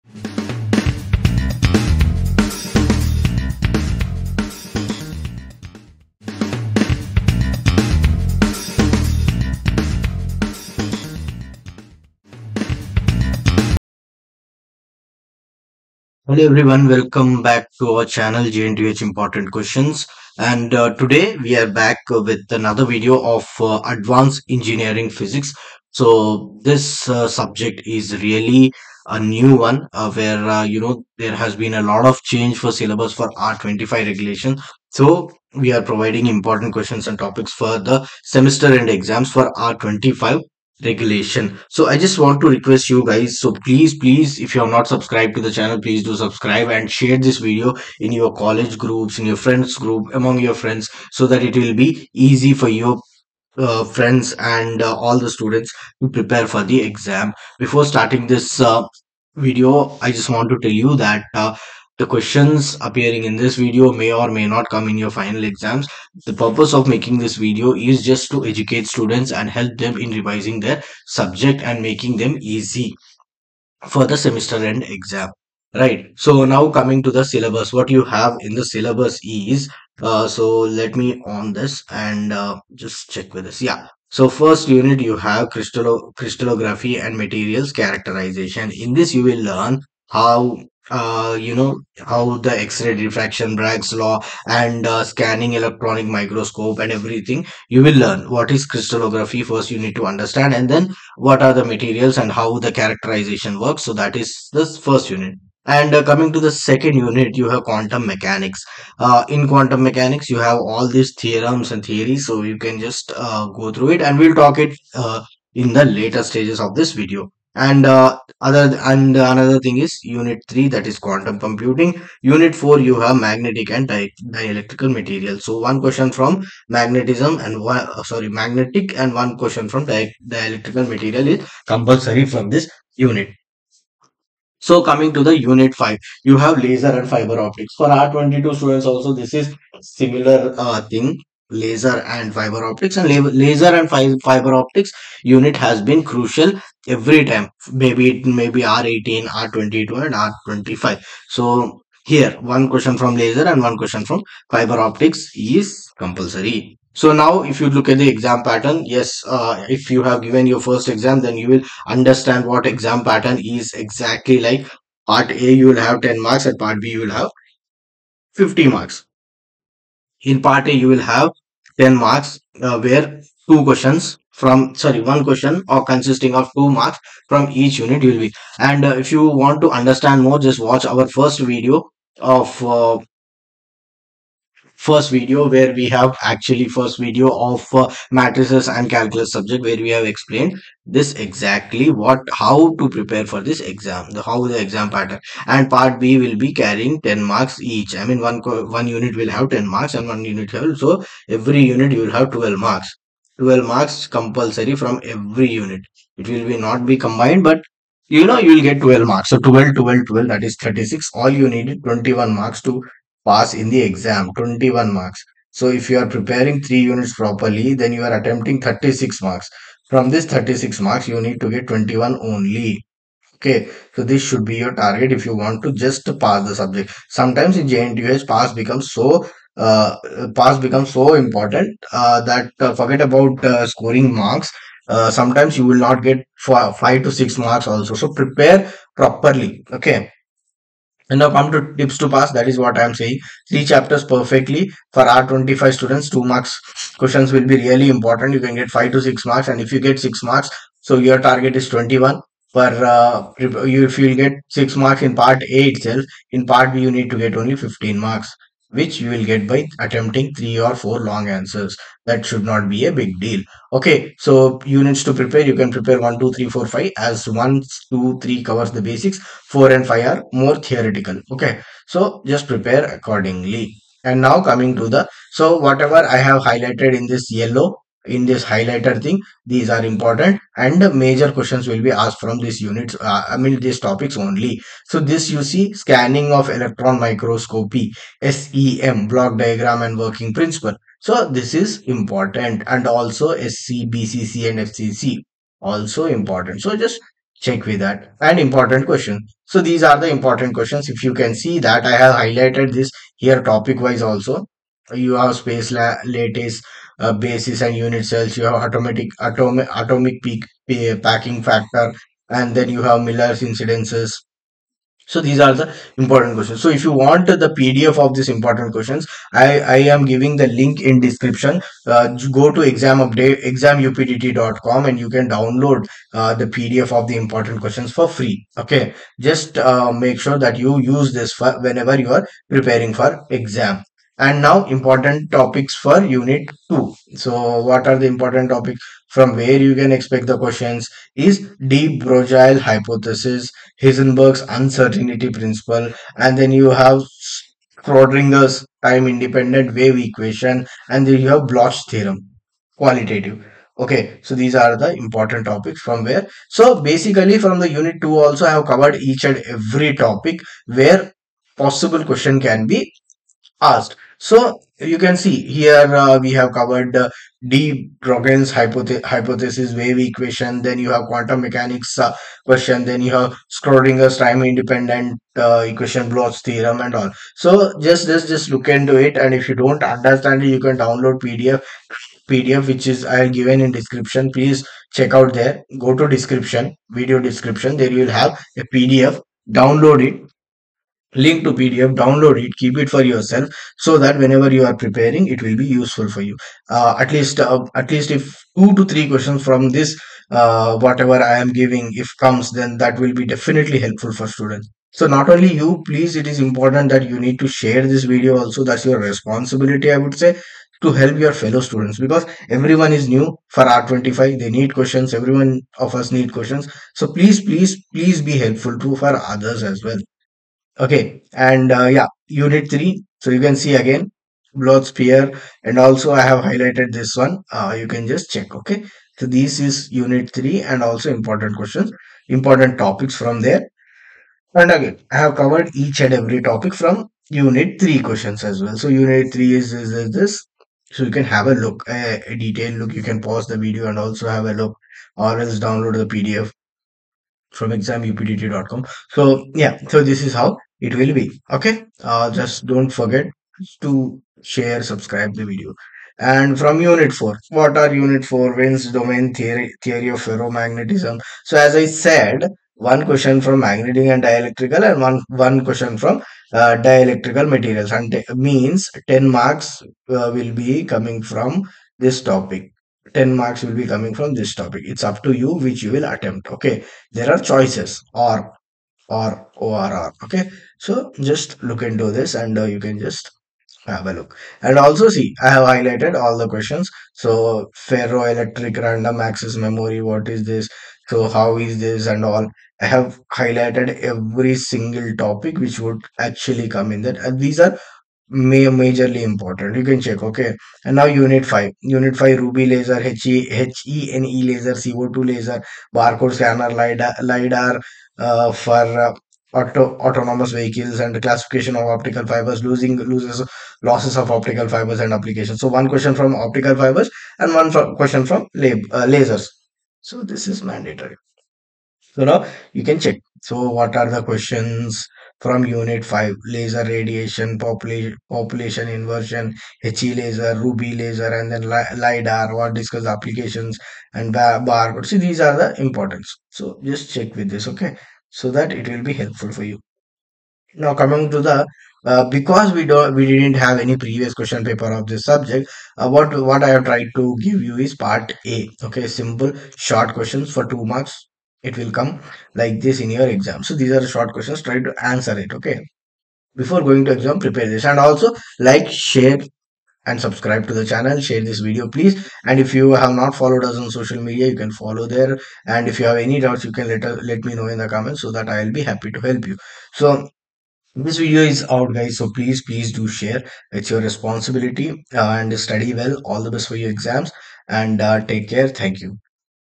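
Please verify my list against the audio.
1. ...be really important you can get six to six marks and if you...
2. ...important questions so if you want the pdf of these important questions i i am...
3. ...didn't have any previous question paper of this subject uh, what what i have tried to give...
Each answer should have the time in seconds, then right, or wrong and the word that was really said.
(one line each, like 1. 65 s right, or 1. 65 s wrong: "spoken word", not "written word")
1. 247 s wrong: "five", not "six"
2. 315 s right
3. 543 s right.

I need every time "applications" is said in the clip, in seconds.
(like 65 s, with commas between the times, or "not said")
515 s, 533 s.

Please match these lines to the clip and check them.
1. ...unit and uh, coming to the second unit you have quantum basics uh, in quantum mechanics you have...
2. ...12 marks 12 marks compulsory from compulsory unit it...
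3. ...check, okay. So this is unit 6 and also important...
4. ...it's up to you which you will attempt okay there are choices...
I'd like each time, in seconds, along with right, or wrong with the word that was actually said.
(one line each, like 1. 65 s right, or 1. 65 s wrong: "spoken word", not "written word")
1. 105 s wrong: "mechanics", not "basics"
2. 202 s wrong: "every", not "compulsory"
3. 428 s wrong: "3", not "6"
4. 474 s right.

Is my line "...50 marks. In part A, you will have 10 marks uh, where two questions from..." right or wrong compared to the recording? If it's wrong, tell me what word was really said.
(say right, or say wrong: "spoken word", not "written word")
right.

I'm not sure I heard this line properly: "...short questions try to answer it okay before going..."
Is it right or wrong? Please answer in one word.
right.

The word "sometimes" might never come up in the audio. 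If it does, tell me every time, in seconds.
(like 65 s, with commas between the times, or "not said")
227 s, 235 s.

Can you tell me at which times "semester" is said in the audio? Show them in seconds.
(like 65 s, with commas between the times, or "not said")
38 s, 74 s.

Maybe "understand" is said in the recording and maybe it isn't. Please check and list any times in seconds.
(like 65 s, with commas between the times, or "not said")
100 s, 161 s, 179 s, 379 s.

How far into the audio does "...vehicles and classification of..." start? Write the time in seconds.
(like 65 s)
510 s.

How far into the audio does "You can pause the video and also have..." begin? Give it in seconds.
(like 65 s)
442 s.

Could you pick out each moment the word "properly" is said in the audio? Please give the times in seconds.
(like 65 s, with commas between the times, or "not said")
217 s, 238 s.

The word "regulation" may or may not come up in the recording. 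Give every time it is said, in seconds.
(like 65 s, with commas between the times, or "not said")
33 s, 40 s.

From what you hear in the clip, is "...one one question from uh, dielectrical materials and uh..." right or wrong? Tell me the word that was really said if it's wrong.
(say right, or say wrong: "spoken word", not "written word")
right.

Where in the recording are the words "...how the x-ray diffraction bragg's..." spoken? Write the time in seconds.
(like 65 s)
92 s.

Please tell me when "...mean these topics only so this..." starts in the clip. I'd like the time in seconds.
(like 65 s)
283 s.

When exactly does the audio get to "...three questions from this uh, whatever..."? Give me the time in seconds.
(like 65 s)
398 s.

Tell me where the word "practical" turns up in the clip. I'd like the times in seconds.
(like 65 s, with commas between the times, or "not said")
not said.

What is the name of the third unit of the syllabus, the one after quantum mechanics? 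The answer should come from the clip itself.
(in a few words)
Quantum computing.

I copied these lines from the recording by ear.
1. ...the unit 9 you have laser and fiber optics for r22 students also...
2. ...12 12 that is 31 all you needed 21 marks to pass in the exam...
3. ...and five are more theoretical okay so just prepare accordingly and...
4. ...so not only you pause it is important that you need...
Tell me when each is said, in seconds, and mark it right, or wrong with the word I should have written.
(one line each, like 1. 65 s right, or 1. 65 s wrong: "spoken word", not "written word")
1. 135 s wrong: "5", not "9"
2. 209 s wrong: "36", not "31"
3. 269 s right
4. 404 s wrong: "please", not "pause".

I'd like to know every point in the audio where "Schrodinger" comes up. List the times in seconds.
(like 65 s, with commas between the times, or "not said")
347 s, 373 s.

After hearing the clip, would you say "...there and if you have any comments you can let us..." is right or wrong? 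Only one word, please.
wrong.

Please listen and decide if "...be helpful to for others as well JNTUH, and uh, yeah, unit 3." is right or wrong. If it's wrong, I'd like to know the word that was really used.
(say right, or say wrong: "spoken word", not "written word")
wrong: "Okay", not "JNTUH".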